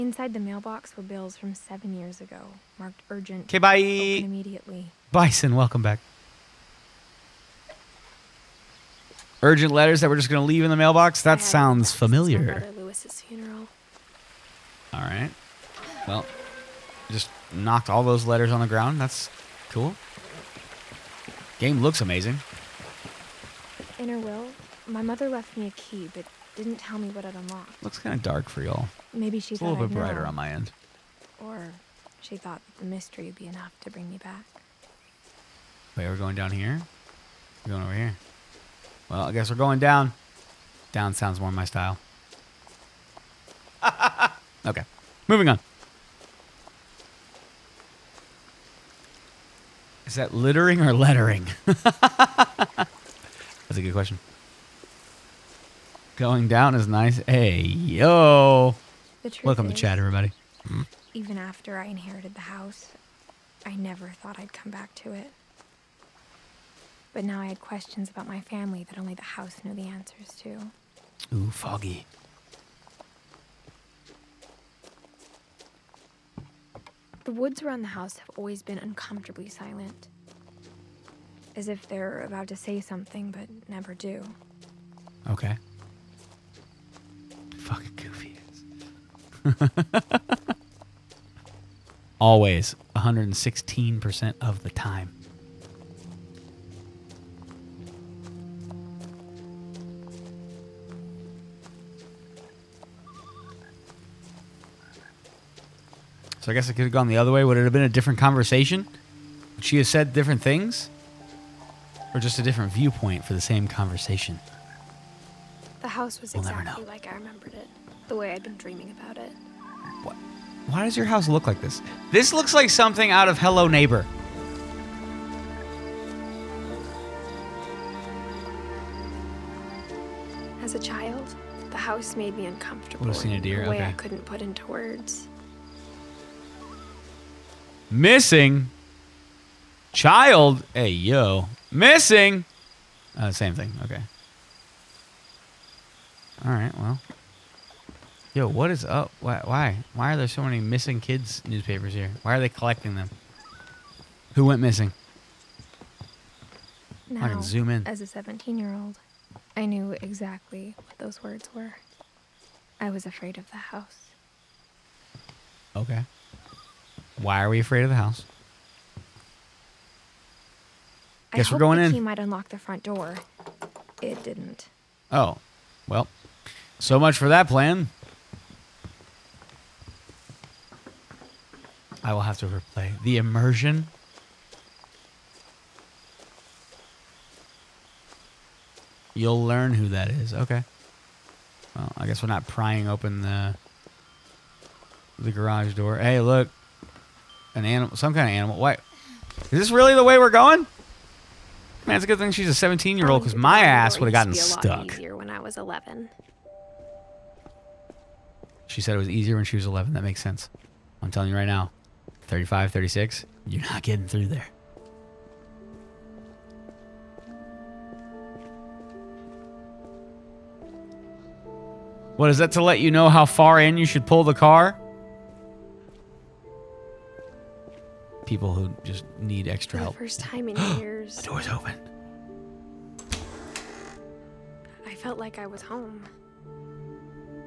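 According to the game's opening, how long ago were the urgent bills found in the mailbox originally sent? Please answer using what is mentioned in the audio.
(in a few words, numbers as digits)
7 years ago.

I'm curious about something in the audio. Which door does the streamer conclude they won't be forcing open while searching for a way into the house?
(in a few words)
The garage door.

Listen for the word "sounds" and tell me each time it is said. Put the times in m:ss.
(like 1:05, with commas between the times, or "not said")
0:11, 0:41.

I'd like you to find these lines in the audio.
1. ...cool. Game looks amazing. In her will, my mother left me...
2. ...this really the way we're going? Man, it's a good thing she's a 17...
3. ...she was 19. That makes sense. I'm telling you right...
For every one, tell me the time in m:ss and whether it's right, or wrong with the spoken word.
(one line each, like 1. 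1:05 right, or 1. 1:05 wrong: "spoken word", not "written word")
1. 0:19 right
2. 3:19 right
3. 3:29 wrong: "11", not "19".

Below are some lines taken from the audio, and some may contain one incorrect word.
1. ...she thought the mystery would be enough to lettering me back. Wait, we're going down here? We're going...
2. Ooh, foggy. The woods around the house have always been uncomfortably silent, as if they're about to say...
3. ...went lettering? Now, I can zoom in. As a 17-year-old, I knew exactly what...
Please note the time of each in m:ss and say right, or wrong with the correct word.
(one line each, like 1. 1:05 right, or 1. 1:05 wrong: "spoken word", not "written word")
1. 0:32 wrong: "bring", not "lettering"
2. 1:11 right
3. 2:34 wrong: "missing", not "lettering".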